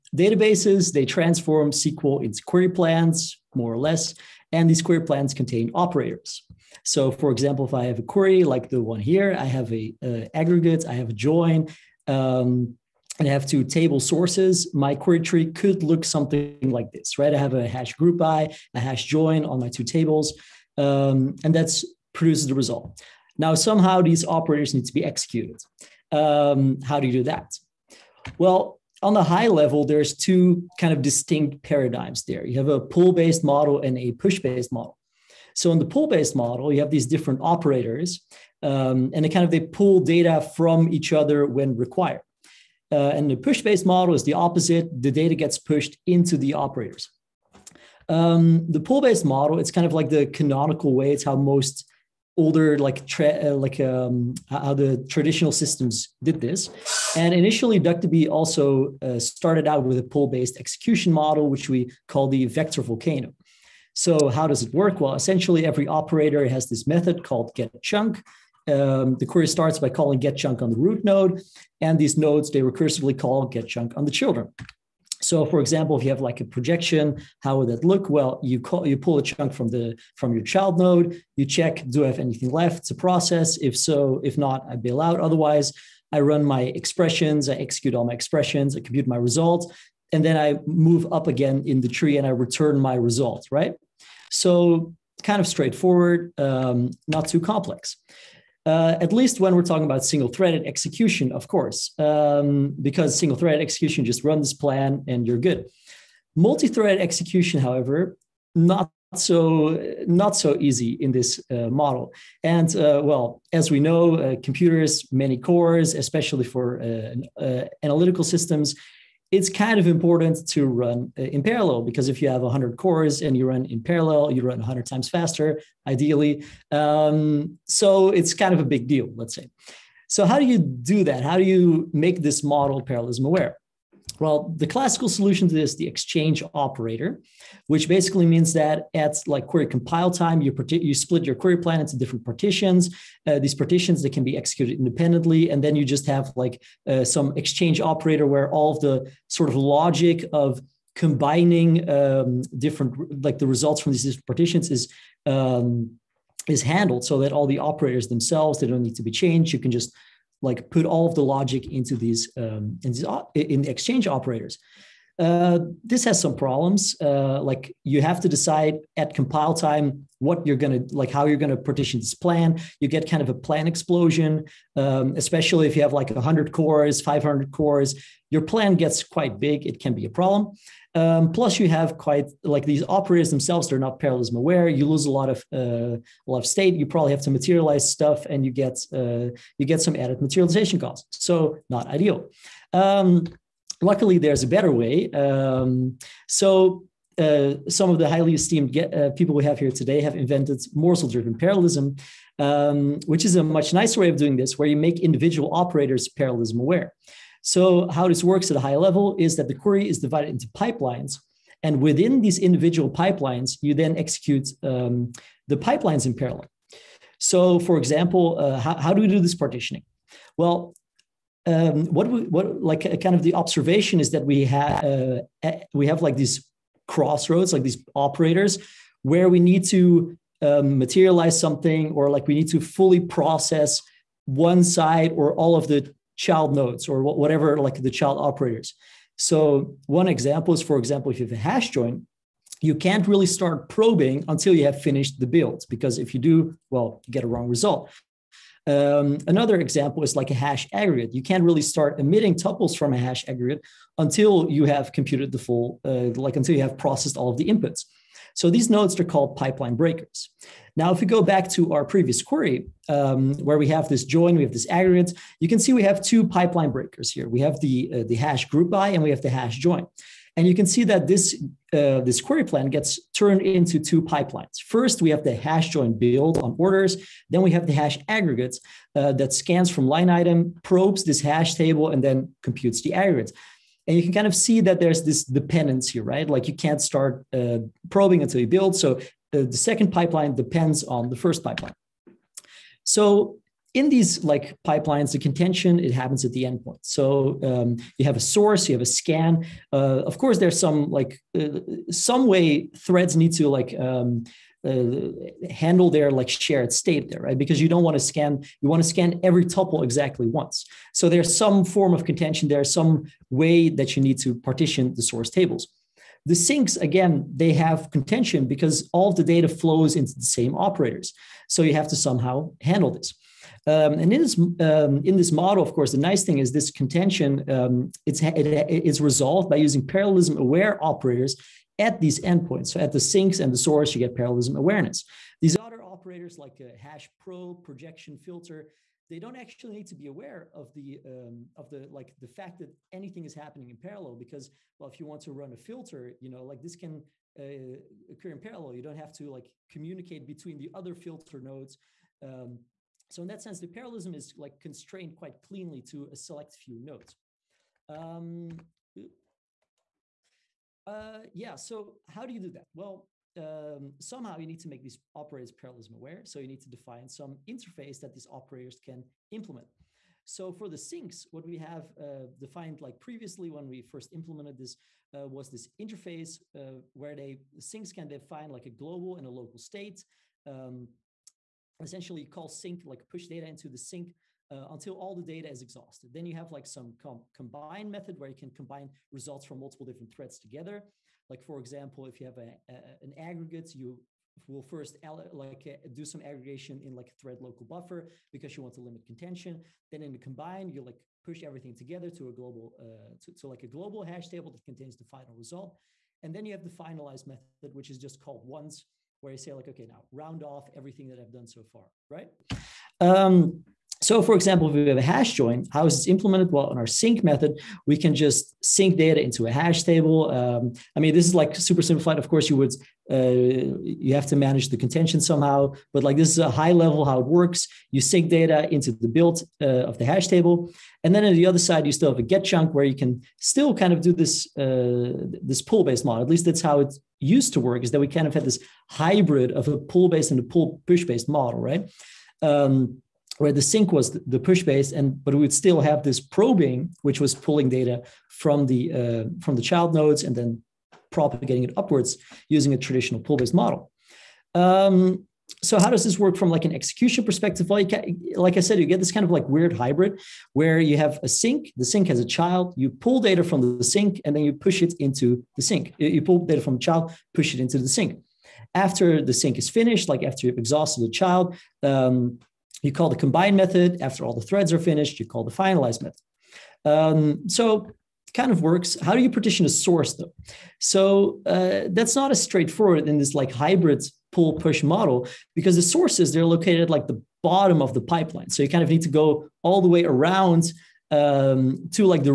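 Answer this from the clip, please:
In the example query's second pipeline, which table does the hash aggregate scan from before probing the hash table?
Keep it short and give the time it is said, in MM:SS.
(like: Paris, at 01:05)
line item, at 04:39.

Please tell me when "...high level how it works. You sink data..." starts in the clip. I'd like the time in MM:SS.
07:06.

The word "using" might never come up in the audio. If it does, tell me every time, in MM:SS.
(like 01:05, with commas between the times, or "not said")
05:29, 07:32.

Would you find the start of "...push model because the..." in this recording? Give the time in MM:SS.
08:04.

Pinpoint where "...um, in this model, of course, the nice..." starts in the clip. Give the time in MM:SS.
05:24.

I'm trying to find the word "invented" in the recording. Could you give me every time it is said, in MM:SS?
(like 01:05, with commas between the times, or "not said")
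03:20.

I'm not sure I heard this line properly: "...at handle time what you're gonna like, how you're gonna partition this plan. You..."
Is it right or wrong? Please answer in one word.
wrong.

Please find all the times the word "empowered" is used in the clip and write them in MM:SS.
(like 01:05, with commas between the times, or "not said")
not said.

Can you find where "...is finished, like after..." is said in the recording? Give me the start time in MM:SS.
07:49.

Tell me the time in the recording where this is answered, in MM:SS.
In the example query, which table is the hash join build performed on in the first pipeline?
04:36.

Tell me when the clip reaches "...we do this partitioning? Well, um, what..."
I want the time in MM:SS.
03:38.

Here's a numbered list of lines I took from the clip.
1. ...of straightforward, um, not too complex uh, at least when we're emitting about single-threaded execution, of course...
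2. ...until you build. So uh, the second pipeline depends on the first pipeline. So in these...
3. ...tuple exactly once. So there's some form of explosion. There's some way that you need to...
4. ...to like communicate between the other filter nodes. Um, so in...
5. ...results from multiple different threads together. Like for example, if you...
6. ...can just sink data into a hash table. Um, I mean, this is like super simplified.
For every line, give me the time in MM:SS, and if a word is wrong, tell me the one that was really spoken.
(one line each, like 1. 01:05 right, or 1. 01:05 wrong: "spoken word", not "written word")
1. 01:35 wrong: "talking", not "emitting"
2. 04:48 right
3. 05:09 wrong: "contention", not "explosion"
4. 05:49 right
5. 06:29 right
6. 06:57 right.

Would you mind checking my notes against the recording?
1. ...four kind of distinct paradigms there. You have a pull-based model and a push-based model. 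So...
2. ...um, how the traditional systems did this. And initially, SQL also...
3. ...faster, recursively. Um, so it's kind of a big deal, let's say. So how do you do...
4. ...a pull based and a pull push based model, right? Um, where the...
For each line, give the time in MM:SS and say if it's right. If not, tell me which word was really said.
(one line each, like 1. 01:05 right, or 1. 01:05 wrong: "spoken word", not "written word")
1. 00:30 wrong: "two", not "four"
2. 00:53 wrong: "DuckDB", not "SQL"
3. 02:05 wrong: "ideally", not "recursively"
4. 07:19 right.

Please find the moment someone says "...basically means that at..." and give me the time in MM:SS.
02:17.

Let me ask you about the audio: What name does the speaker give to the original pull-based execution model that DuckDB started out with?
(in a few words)
vector volcano.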